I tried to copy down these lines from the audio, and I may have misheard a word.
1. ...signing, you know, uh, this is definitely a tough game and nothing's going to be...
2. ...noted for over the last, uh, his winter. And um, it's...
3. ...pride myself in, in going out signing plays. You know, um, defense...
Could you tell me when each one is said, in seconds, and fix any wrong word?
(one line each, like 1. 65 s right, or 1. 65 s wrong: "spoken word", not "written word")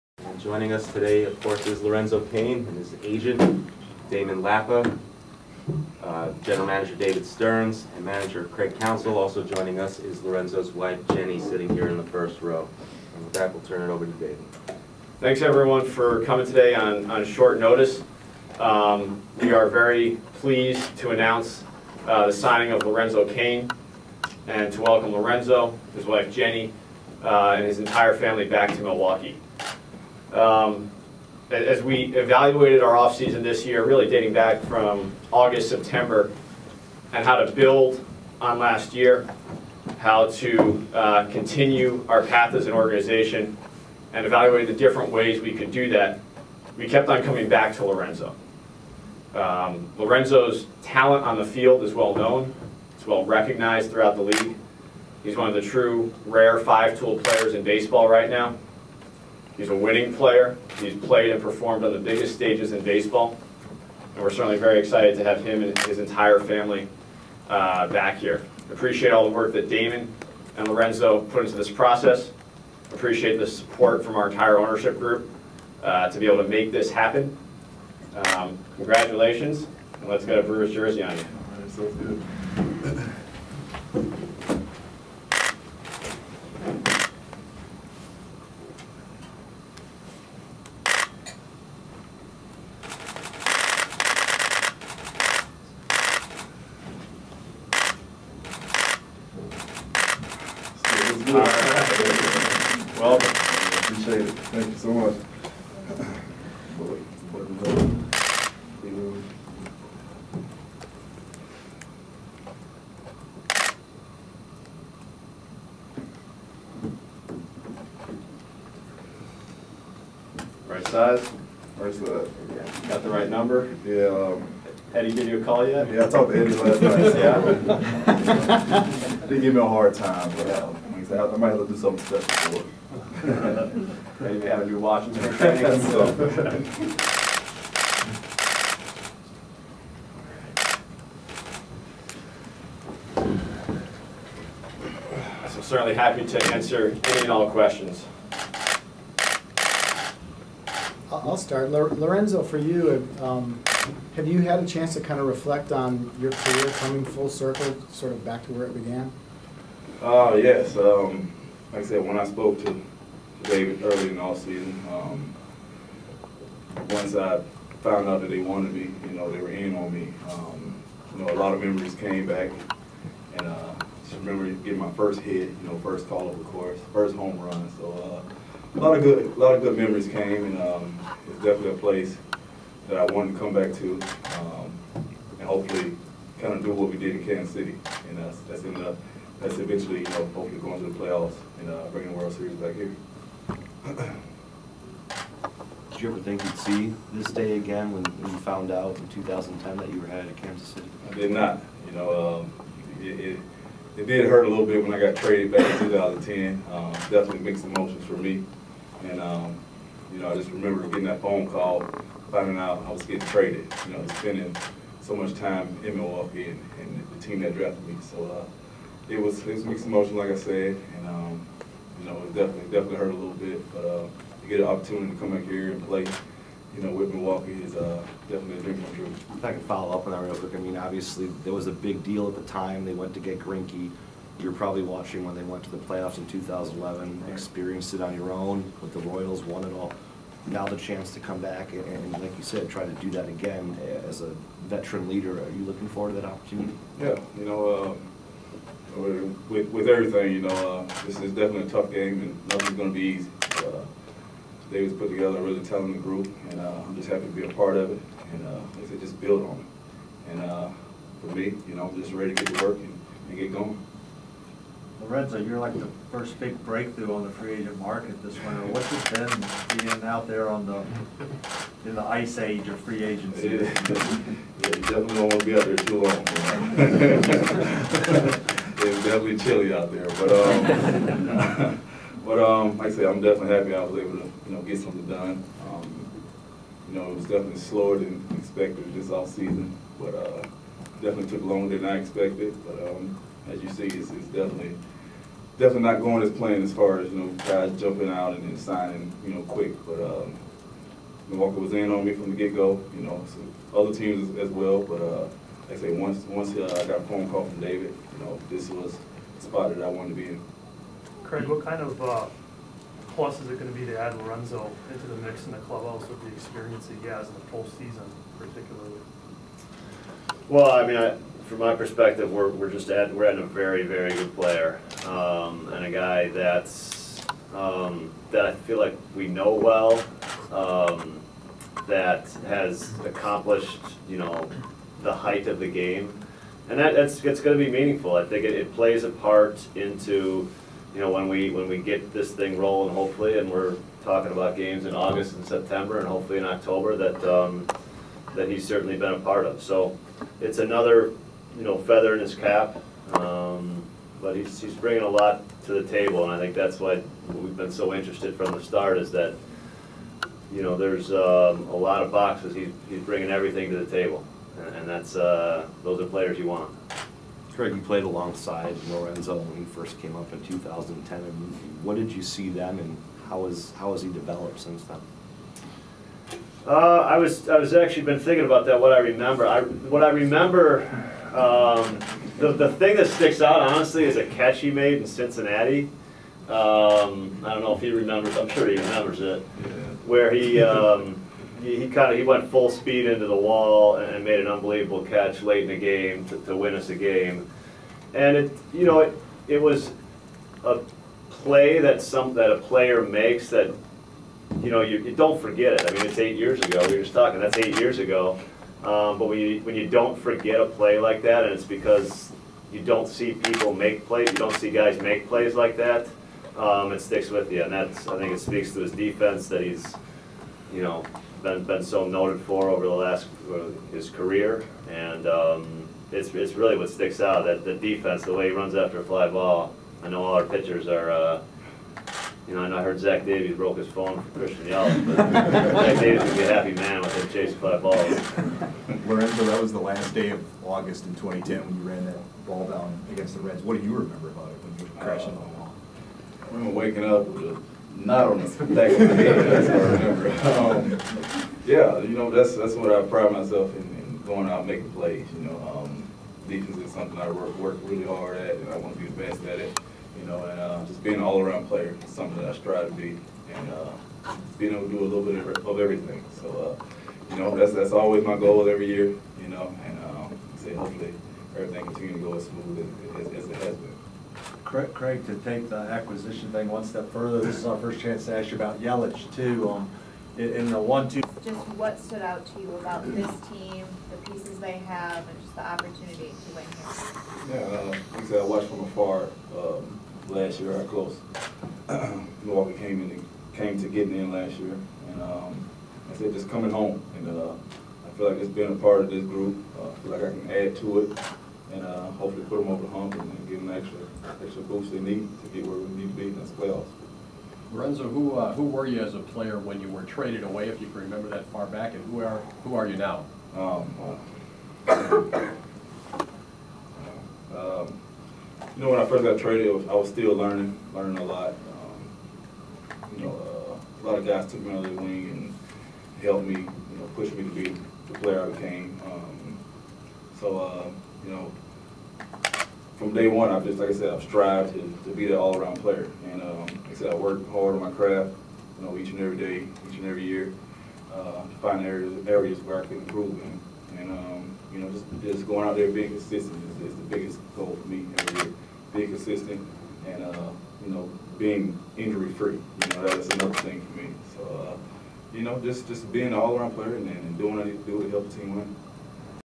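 1. 249 s wrong: "everything", not "signing"
2. 422 s wrong: "career", not "winter"
3. 453 s wrong: "making", not "signing".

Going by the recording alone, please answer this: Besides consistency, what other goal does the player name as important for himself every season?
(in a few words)
being injury-free.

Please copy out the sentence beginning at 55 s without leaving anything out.
He's one of the true rare five-tool players in baseball right now.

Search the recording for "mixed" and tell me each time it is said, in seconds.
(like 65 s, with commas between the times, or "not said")
207 s, 219 s.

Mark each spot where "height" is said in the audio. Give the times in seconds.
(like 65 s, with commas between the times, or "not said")
335 s.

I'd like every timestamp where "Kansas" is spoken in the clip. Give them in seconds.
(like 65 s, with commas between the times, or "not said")
187 s, 200 s.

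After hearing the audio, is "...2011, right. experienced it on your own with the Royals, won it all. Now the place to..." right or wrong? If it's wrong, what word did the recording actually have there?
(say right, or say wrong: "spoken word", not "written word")
wrong: "chance", not "place".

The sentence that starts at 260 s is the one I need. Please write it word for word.
And uh, for me, you know, I'm just ready to get to work and, and get going.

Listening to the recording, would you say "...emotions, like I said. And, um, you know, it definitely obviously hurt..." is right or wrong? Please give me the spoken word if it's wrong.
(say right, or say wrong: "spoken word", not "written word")
wrong: "definitely", not "obviously".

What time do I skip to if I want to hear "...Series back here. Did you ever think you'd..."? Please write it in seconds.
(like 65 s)
192 s.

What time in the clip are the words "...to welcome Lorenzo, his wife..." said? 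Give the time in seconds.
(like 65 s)
24 s.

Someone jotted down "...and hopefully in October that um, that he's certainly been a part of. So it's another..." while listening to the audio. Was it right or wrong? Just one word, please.
right.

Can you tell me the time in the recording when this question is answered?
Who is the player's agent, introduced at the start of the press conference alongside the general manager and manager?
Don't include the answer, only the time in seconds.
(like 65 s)
4 s.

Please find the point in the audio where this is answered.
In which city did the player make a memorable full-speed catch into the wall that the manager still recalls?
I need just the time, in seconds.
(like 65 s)
385 s.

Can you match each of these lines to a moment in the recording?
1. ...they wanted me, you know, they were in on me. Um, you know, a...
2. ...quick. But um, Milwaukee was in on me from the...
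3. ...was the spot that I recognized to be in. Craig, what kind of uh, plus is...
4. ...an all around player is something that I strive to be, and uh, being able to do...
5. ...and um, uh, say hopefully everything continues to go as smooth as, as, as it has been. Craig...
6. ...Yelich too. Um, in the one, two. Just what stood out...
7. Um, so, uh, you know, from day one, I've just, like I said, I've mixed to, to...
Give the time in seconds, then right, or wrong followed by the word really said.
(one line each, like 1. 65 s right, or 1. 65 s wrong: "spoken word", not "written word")
1. 168 s right
2. 299 s right
3. 308 s wrong: "wanted", not "recognized"
4. 461 s right
5. 469 s right
6. 478 s right
7. 529 s wrong: "strived", not "mixed".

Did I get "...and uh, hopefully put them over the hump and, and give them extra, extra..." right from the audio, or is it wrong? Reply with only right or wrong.
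right.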